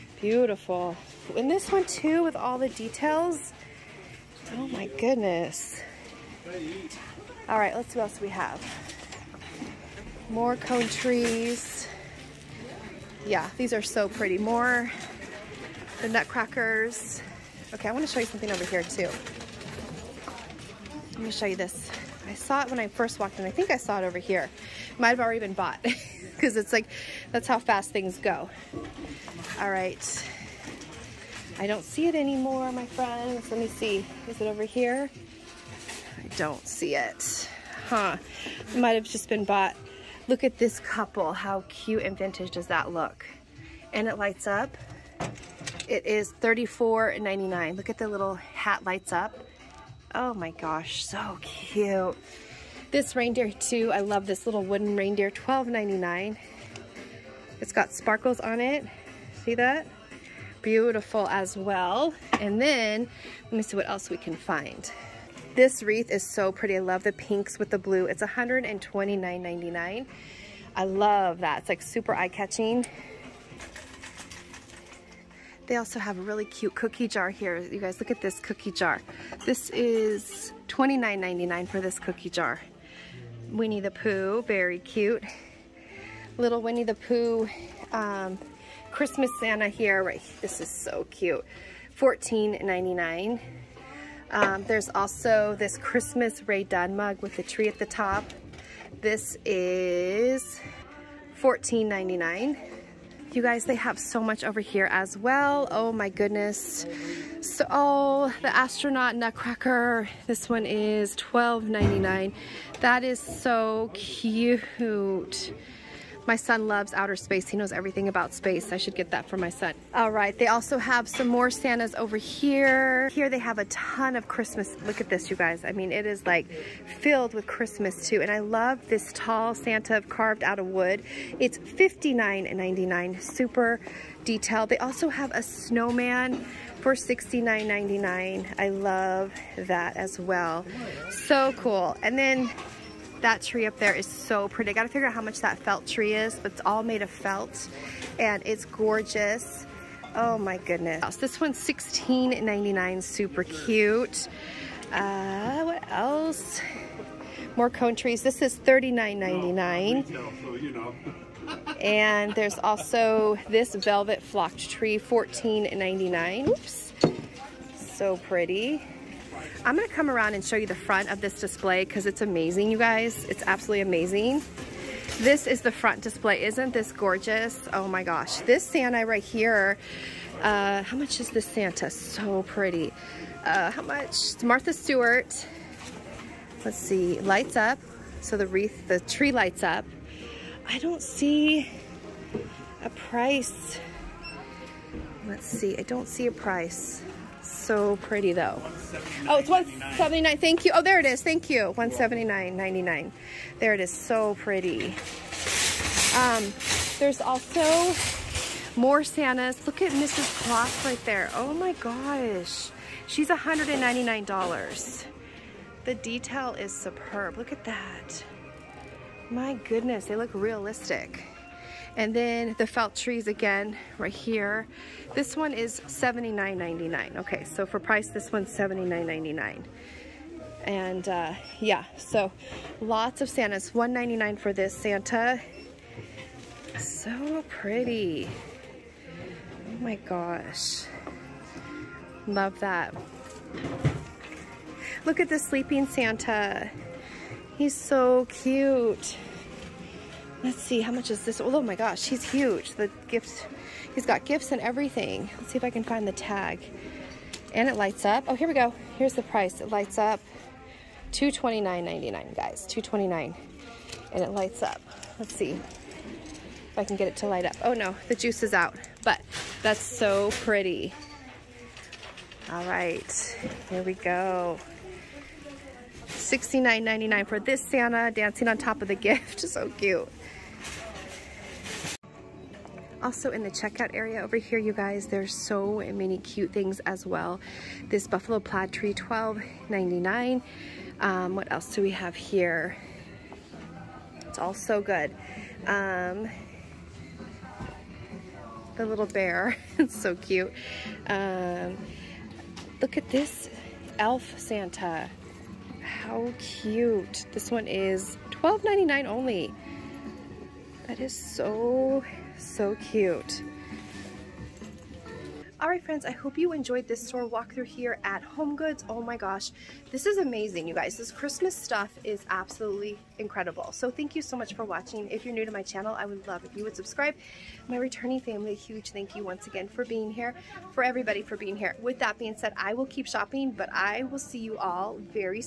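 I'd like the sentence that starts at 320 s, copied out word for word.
This Christmas stuff is absolutely incredible.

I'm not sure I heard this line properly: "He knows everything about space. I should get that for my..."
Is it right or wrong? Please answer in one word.
right.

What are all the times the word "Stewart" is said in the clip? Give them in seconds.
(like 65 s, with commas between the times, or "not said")
184 s.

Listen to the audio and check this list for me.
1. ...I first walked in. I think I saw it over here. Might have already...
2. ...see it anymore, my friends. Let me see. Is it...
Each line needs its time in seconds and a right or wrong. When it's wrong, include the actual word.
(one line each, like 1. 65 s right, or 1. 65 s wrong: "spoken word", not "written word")
1. 22 s right
2. 31 s right.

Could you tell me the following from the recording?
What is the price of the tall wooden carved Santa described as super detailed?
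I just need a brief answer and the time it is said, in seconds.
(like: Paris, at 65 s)
$59.99, at 131 s.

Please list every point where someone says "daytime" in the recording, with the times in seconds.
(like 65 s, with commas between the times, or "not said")
not said.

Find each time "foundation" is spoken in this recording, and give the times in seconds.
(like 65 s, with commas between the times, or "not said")
not said.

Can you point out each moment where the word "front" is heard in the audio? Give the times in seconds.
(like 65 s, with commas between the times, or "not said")
170 s, 175 s.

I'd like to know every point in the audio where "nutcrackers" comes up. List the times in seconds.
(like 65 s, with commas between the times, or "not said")
16 s, 109 s.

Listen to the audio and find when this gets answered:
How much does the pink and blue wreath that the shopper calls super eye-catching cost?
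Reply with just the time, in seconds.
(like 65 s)
68 s.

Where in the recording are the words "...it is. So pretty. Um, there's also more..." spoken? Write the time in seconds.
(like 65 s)
203 s.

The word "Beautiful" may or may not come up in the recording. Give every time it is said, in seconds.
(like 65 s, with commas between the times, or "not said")
0 s, 60 s.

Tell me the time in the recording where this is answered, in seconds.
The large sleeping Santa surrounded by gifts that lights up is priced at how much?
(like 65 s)
261 s.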